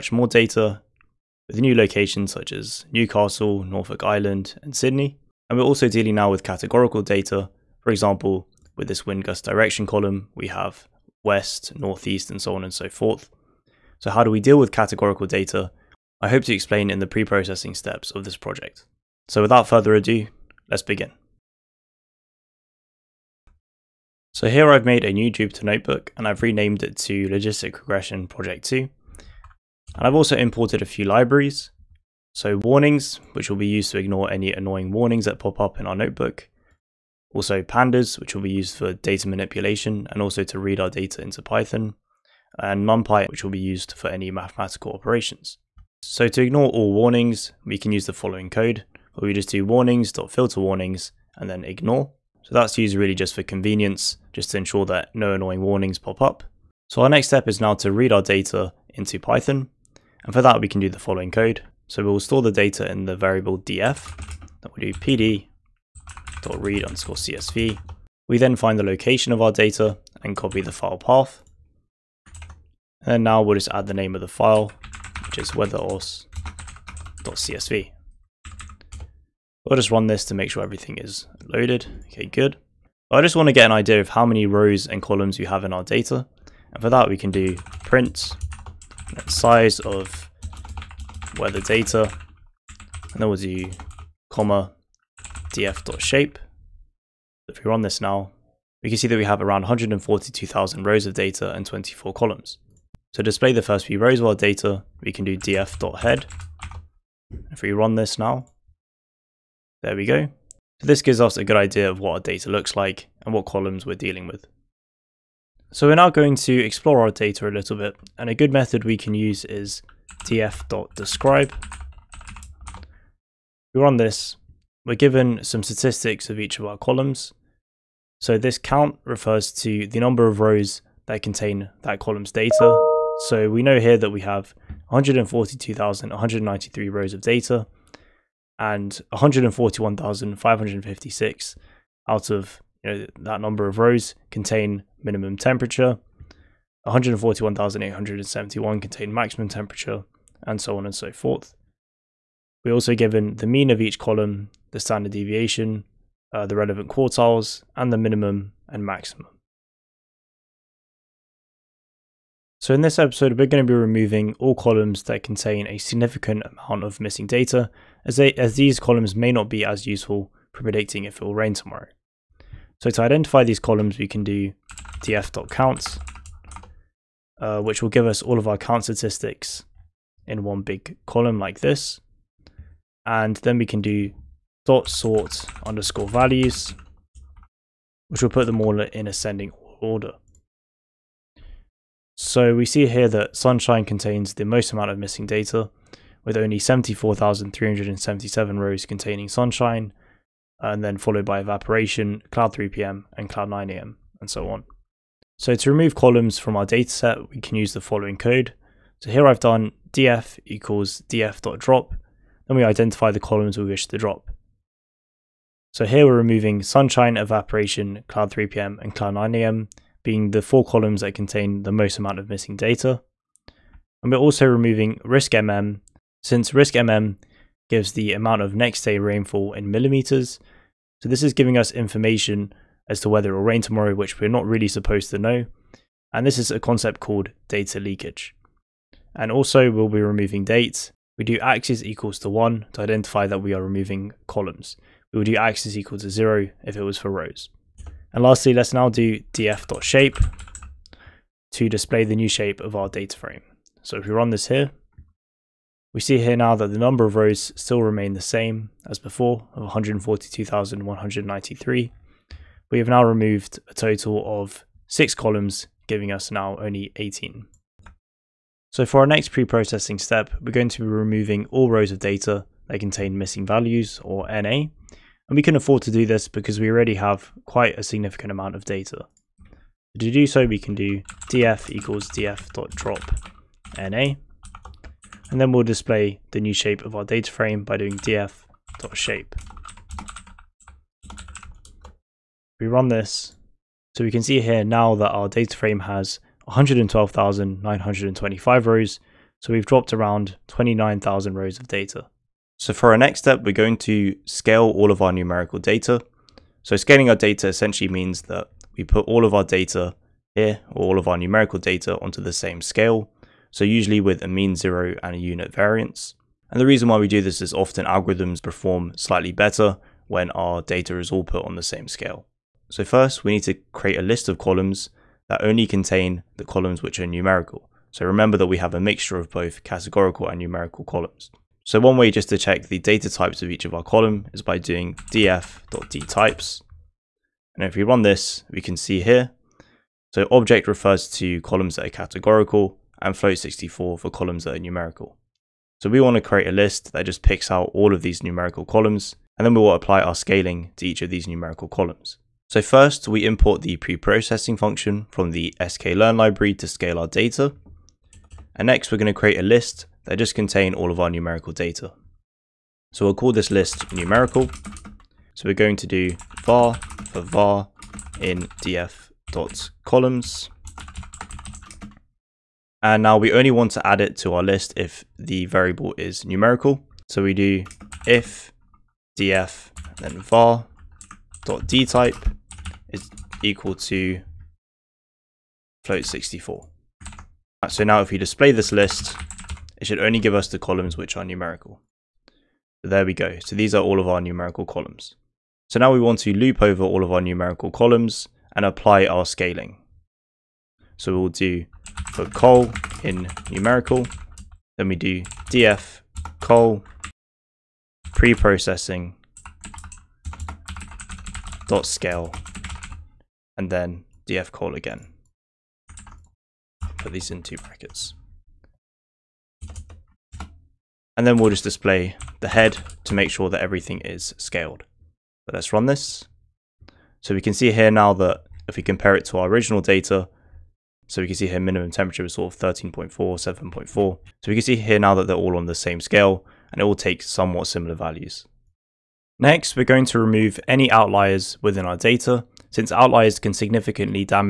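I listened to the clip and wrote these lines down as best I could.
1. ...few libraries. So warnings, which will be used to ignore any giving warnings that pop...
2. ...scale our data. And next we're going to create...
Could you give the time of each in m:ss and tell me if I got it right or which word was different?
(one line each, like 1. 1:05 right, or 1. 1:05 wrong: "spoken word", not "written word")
1. 0:30 wrong: "annoying", not "giving"
2. 5:56 right.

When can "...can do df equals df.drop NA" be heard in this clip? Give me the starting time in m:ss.
4:40.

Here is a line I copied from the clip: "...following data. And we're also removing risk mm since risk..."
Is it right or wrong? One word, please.
wrong.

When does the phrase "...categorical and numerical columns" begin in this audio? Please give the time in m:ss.
5:29.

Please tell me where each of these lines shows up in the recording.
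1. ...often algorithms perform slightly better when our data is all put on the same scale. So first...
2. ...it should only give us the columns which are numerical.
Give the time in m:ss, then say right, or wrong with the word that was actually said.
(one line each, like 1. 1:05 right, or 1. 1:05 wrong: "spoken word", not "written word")
1. 5:17 right
2. 6:29 right.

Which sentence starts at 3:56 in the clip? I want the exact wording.
And this is a concept called data leakage.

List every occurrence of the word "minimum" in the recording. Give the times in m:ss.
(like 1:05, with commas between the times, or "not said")
2:25, 2:37, 7:11.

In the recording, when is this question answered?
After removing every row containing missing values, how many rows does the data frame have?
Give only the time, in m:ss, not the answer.
4:56.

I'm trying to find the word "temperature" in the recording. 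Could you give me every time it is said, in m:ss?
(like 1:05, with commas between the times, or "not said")
2:25, 2:29, 7:11.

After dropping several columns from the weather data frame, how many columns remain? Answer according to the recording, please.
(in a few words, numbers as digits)
18.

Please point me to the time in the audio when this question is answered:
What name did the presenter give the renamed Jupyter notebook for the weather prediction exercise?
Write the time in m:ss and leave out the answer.
0:27.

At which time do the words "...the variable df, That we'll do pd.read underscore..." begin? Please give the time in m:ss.
1:03.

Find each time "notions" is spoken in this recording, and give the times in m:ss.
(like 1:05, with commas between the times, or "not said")
not said.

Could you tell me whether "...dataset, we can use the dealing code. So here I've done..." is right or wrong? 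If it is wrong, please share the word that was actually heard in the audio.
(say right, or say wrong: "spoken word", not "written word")
wrong: "following", not "dealing".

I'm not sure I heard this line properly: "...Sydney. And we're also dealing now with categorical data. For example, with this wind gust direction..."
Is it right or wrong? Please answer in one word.
right.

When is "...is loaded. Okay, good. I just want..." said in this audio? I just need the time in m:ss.
1:20.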